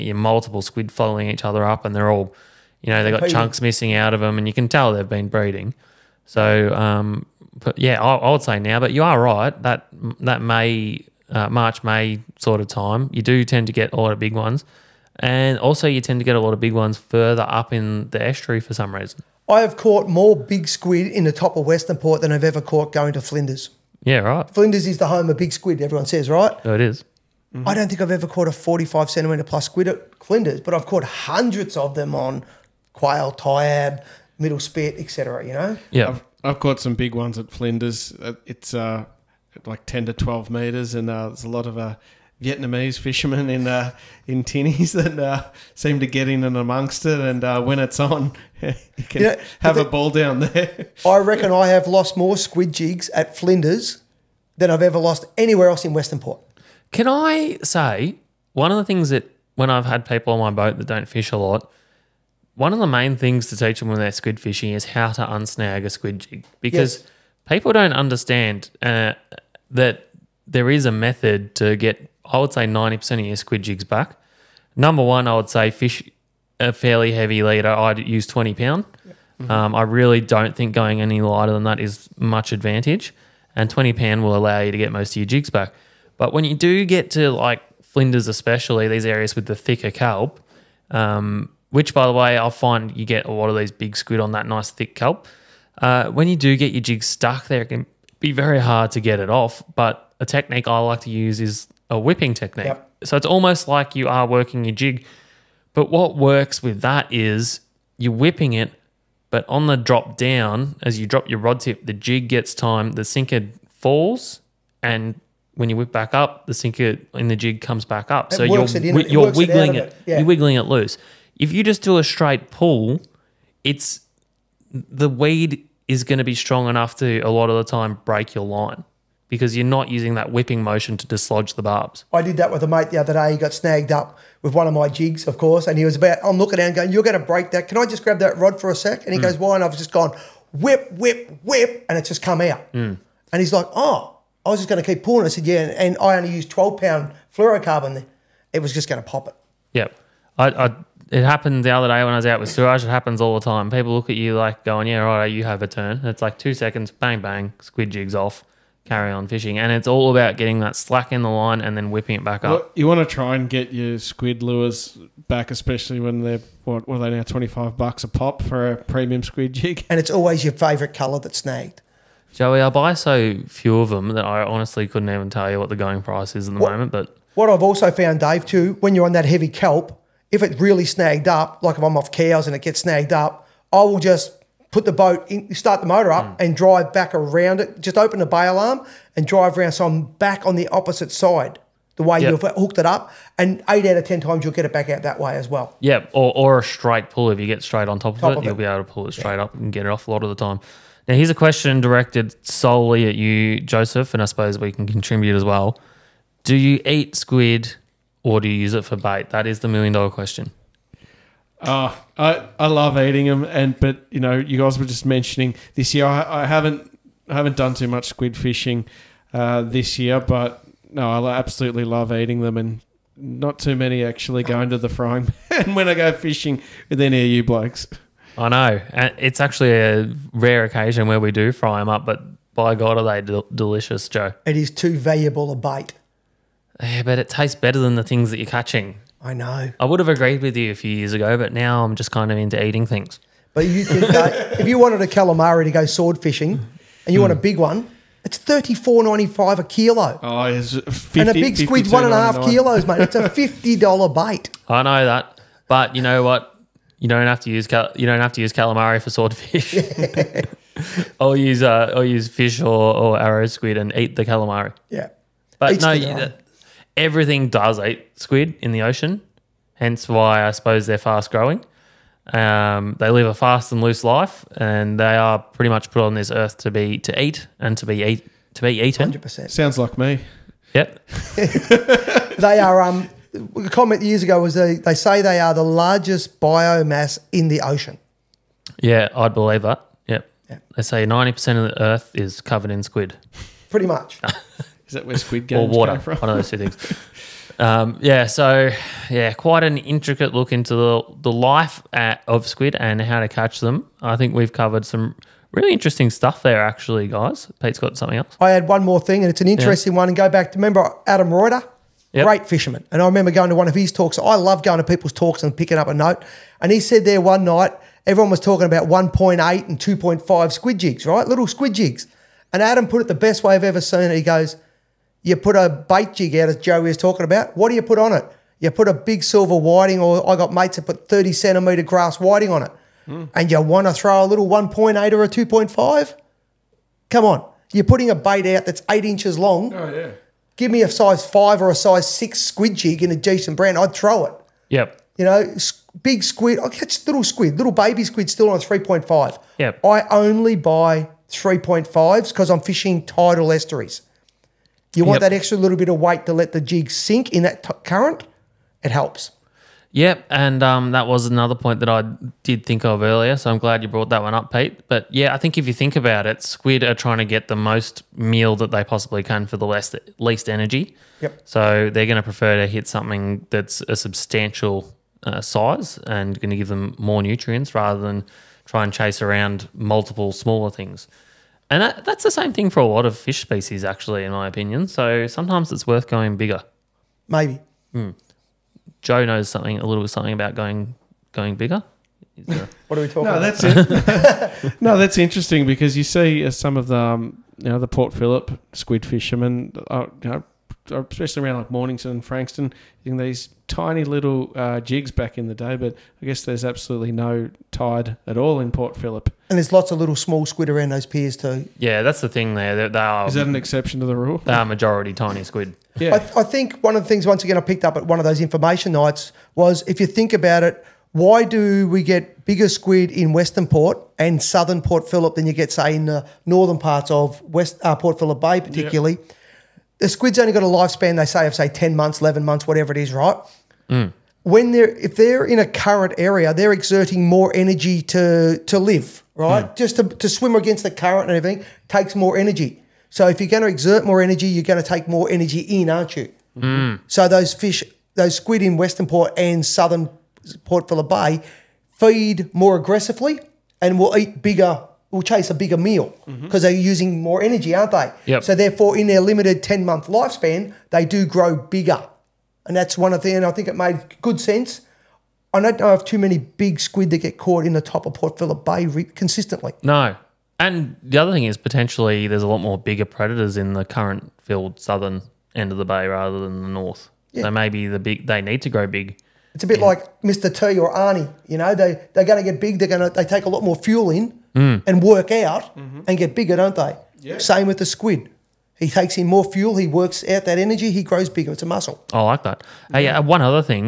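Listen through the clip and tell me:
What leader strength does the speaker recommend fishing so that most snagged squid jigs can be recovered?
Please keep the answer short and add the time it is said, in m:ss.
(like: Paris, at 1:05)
20 pound, at 1:17.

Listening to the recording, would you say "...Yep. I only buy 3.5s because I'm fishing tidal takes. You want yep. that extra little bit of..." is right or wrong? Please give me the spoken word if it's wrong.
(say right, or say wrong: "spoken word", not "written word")
wrong: "estuaries", not "takes".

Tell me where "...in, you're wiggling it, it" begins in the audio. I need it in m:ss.
1:58.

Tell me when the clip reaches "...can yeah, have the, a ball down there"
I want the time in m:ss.
0:49.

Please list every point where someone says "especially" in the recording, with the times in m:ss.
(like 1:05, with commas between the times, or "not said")
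1:28, 2:45, 6:40.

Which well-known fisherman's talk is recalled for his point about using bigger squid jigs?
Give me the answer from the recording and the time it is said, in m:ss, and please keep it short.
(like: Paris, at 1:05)
Adam Reuter, at 5:11.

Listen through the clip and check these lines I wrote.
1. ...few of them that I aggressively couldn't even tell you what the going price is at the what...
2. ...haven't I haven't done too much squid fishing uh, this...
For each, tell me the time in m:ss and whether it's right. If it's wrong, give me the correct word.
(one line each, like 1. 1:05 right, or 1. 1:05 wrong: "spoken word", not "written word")
1. 2:53 wrong: "honestly", not "aggressively"
2. 3:36 right.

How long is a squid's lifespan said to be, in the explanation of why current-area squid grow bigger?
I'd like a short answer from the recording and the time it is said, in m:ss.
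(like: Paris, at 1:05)
10 months, at 7:11.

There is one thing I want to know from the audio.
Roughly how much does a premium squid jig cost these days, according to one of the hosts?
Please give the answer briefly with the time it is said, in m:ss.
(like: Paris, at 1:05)
$25, at 2:47.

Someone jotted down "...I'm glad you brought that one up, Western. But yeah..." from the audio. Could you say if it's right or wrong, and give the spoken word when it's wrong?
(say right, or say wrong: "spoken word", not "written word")
wrong: "Pete", not "Western".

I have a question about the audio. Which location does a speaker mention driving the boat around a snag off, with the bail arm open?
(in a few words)
Cowes.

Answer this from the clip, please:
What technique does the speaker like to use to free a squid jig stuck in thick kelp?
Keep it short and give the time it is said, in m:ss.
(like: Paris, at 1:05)
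whipping technique, at 1:41.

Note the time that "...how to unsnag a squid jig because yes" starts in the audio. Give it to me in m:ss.
1:04.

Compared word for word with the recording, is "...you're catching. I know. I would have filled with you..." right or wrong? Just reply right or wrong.
wrong.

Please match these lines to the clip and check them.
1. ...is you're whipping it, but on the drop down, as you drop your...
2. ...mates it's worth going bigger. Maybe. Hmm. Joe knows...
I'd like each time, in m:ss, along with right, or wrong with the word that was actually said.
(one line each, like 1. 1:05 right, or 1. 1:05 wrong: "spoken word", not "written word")
1. 1:47 right
2. 6:25 wrong: "sometimes", not "mates".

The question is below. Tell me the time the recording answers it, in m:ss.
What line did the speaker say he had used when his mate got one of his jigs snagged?
2:26.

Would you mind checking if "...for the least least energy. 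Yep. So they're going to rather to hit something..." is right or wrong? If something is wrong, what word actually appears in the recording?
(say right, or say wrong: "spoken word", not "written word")
wrong: "prefer", not "rather".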